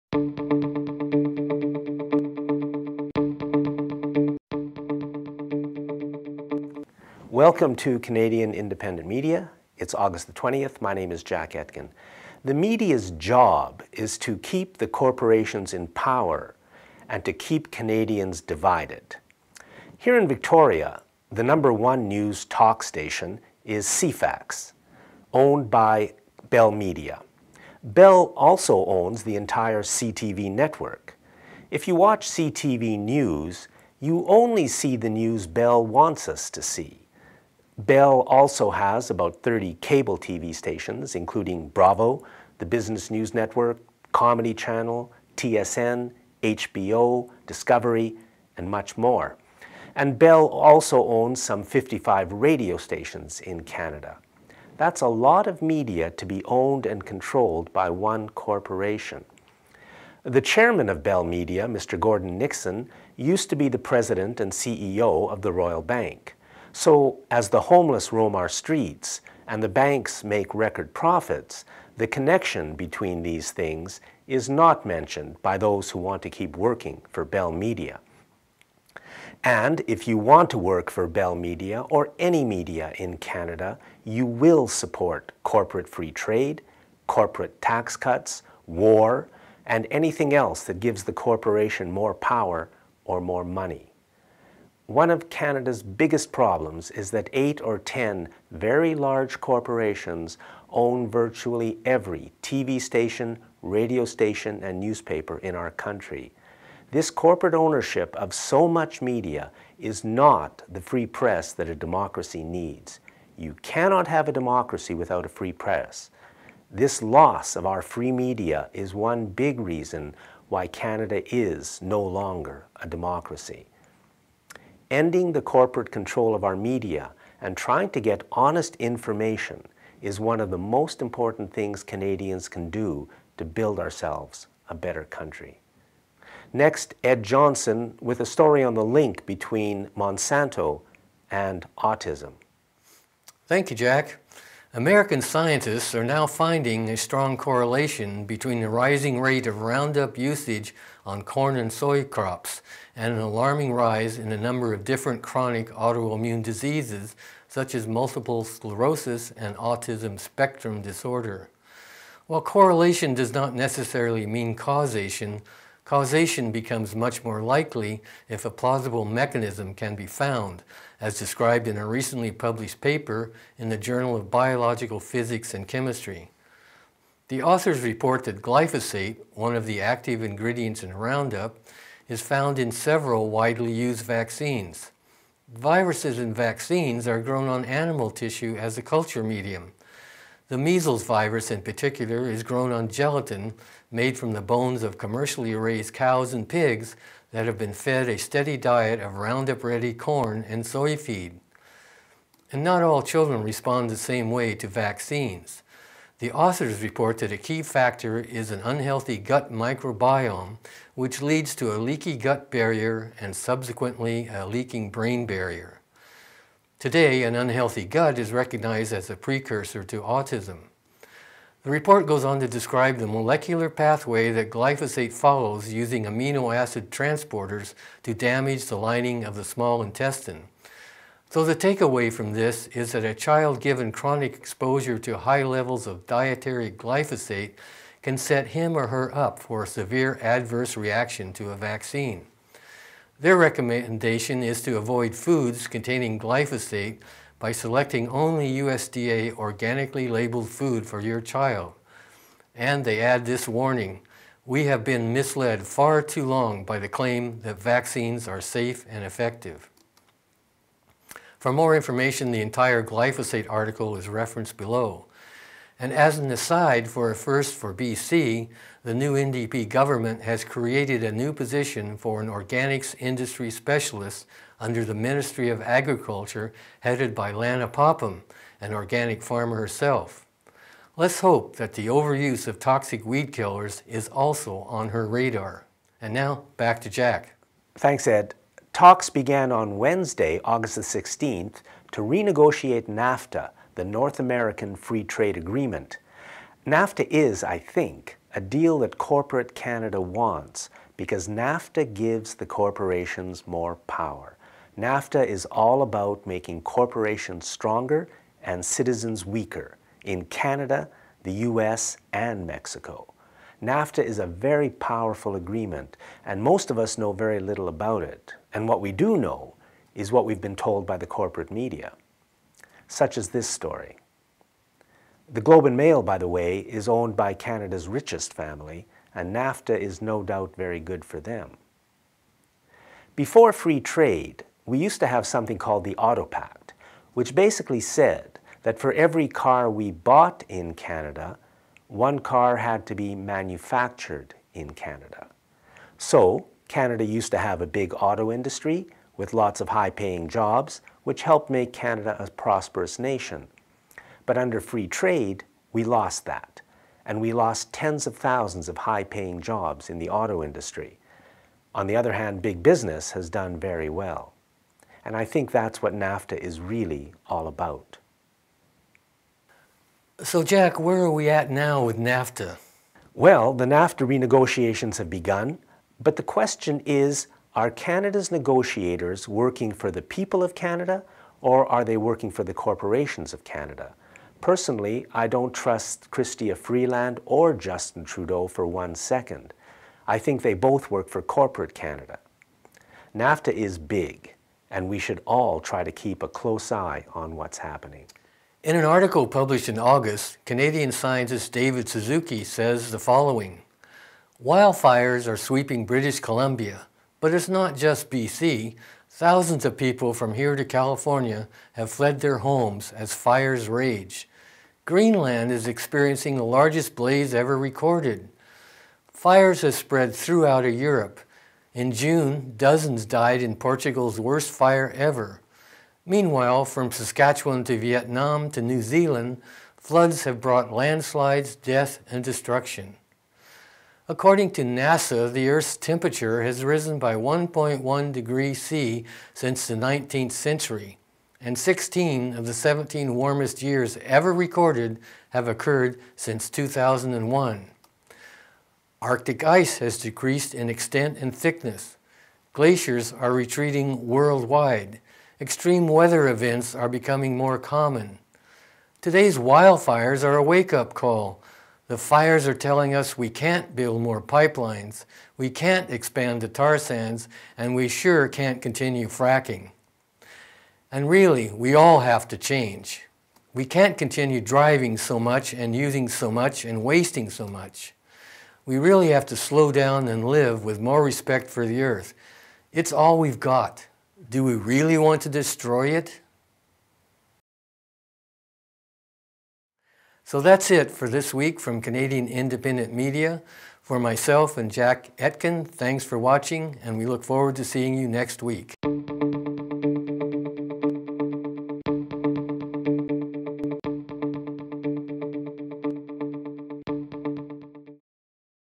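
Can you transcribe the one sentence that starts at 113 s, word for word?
You cannot have a democracy without a free press.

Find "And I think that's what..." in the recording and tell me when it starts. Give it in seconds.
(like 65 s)
365 s.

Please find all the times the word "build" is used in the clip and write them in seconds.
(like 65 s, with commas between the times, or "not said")
133 s, 463 s.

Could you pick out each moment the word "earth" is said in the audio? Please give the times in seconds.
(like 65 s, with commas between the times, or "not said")
435 s, 481 s.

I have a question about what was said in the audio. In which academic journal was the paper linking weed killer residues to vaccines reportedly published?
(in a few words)
Journal of Biological Physics and Chemistry.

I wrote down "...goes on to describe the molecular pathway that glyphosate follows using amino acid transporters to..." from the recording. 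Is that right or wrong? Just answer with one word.
right.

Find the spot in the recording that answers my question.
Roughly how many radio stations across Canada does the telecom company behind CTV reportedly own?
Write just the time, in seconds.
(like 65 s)
51 s.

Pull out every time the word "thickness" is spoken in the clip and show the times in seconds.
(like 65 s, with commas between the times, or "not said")
451 s.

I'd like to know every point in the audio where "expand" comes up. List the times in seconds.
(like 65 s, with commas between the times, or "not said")
465 s.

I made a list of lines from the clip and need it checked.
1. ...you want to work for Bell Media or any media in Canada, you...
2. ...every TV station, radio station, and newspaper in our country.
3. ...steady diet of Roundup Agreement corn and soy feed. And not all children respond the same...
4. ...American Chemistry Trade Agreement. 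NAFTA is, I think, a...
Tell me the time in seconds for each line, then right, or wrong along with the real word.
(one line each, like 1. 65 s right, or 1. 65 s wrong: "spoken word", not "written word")
1. 80 s right
2. 101 s right
3. 198 s wrong: "Ready", not "Agreement"
4. 294 s wrong: "Free", not "Chemistry".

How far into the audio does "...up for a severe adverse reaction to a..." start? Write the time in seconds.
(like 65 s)
239 s.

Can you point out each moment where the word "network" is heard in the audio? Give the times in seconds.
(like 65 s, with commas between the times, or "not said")
30 s, 43 s.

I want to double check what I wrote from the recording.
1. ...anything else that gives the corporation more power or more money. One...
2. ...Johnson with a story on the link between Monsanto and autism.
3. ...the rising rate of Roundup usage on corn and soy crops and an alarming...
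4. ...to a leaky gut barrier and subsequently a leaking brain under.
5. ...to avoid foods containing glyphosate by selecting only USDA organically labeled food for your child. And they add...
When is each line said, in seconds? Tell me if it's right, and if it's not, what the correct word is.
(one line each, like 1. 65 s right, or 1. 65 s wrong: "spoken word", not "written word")
1. 89 s right
2. 137 s right
3. 148 s right
4. 211 s wrong: "barrier", not "under"
5. 244 s right.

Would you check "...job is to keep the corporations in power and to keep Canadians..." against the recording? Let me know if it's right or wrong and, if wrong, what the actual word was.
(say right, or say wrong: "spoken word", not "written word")
right.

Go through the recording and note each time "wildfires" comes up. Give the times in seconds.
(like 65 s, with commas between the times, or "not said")
404 s, 459 s.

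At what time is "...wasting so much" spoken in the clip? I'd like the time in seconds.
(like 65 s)
476 s.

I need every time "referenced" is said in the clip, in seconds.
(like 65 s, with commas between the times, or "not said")
264 s.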